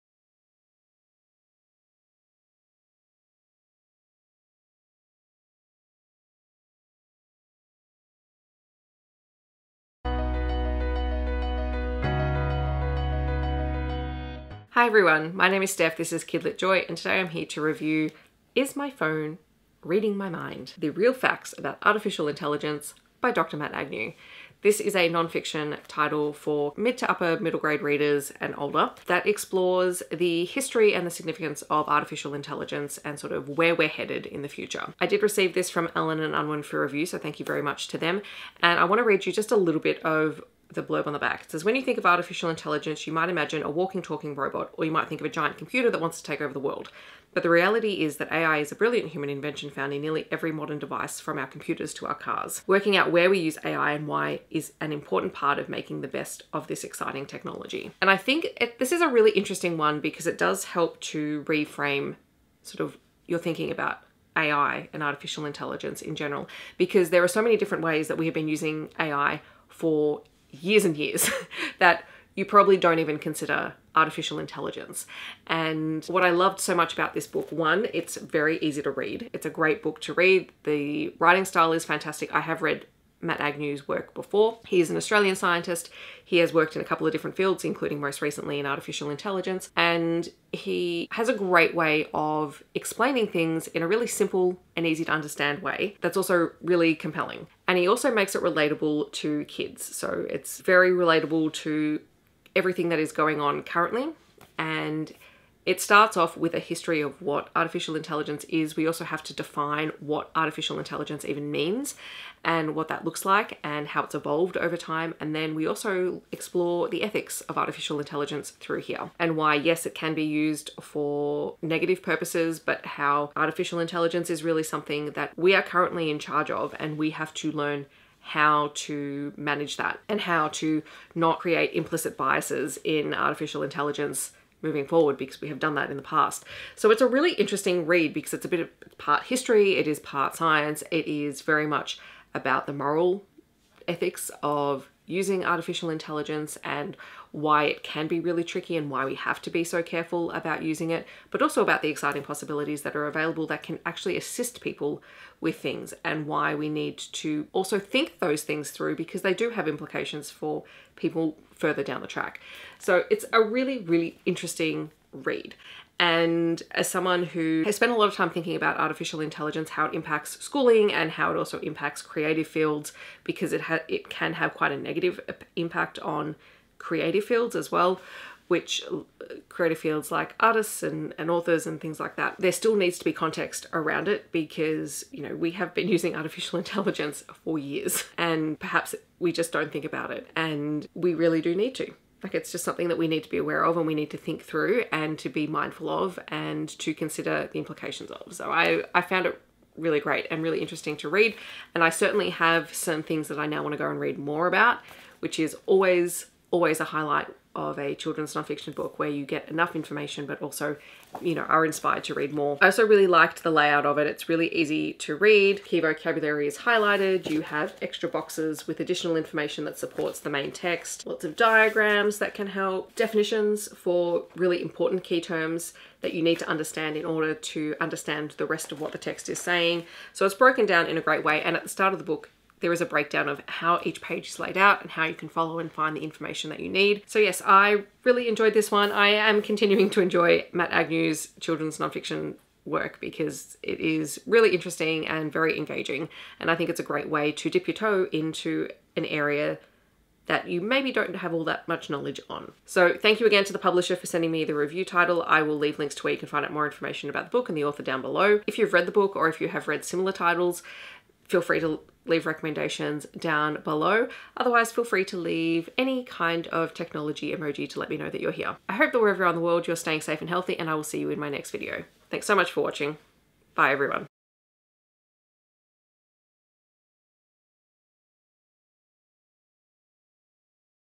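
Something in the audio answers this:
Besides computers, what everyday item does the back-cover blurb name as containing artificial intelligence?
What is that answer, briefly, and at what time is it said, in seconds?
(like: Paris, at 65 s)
cars, at 52 s.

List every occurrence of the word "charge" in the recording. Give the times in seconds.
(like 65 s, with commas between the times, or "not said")
126 s.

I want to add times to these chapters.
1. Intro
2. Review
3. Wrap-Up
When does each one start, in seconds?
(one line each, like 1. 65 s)
1. 16 s
2. 38 s
3. 237 s.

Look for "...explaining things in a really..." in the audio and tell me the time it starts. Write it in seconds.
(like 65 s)
92 s.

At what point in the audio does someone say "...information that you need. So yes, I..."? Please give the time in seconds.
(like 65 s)
236 s.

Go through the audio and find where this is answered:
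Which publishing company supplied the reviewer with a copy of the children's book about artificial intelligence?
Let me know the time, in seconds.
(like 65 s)
35 s.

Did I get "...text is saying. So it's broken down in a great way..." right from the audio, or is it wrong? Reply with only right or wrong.
right.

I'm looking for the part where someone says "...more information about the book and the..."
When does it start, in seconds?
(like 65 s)
256 s.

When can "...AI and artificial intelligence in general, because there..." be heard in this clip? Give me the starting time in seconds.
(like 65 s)
64 s.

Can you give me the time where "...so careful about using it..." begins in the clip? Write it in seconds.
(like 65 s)
149 s.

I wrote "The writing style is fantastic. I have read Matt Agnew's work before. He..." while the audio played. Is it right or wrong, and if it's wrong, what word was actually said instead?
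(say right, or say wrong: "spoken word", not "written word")
right.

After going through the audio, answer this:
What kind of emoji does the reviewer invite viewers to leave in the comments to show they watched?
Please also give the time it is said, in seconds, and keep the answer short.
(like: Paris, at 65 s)
technology emoji, at 266 s.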